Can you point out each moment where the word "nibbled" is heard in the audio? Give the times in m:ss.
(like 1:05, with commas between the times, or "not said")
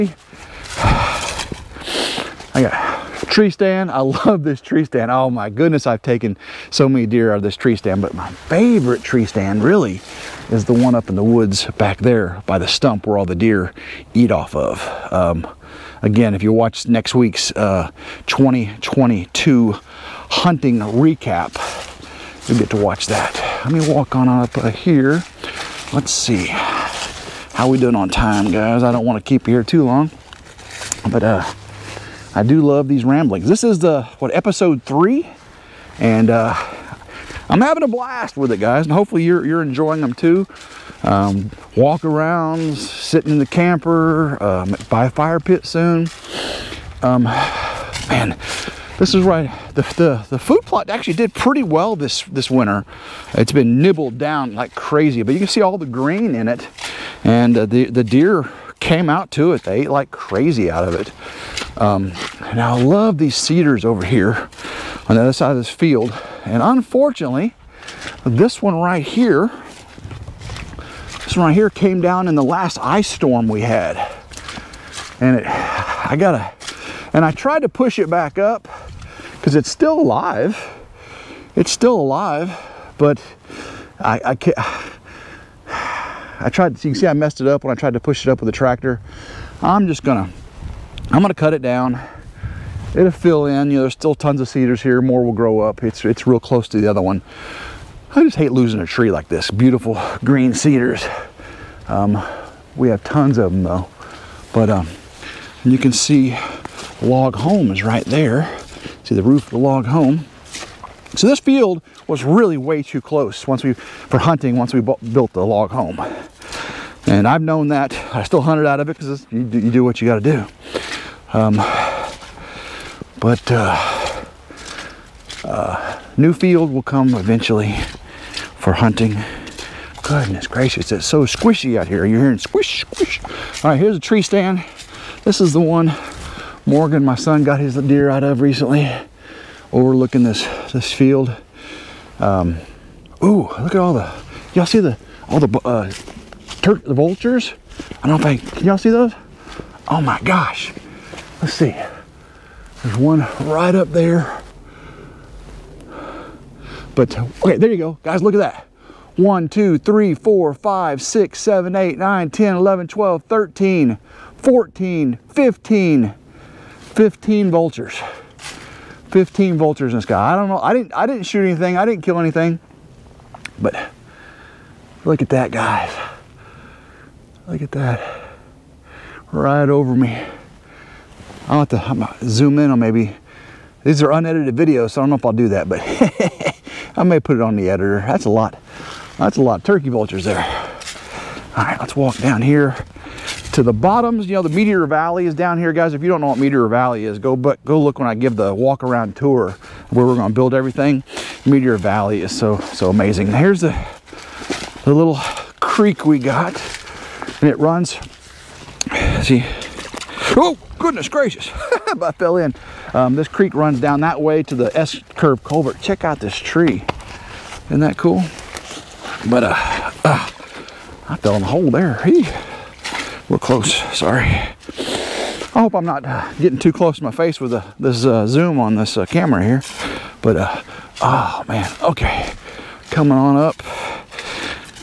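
0:53.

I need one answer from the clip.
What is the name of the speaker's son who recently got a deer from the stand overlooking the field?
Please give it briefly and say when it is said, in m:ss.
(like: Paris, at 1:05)
Morgan, at 2:16.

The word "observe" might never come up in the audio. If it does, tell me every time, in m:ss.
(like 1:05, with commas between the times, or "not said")
not said.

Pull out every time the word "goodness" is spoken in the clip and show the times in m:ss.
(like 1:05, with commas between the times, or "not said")
0:05, 2:10, 3:30.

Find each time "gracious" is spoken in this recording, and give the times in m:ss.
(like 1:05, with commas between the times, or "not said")
2:10, 3:31.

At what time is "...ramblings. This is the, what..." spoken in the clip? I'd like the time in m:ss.
0:33.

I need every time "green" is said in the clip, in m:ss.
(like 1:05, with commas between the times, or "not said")
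0:55, 1:40.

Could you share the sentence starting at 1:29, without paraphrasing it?
I'm just gonna, I'm gonna cut it down.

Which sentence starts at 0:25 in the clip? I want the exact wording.
Let's see how we doing on time, guys.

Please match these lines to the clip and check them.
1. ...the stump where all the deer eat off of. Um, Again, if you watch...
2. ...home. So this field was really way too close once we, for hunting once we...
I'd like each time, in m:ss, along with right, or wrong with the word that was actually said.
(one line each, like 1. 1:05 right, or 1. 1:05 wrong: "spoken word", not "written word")
1. 0:12 right
2. 1:49 right.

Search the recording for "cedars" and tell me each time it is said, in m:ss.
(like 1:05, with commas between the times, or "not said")
1:03, 1:34, 1:40.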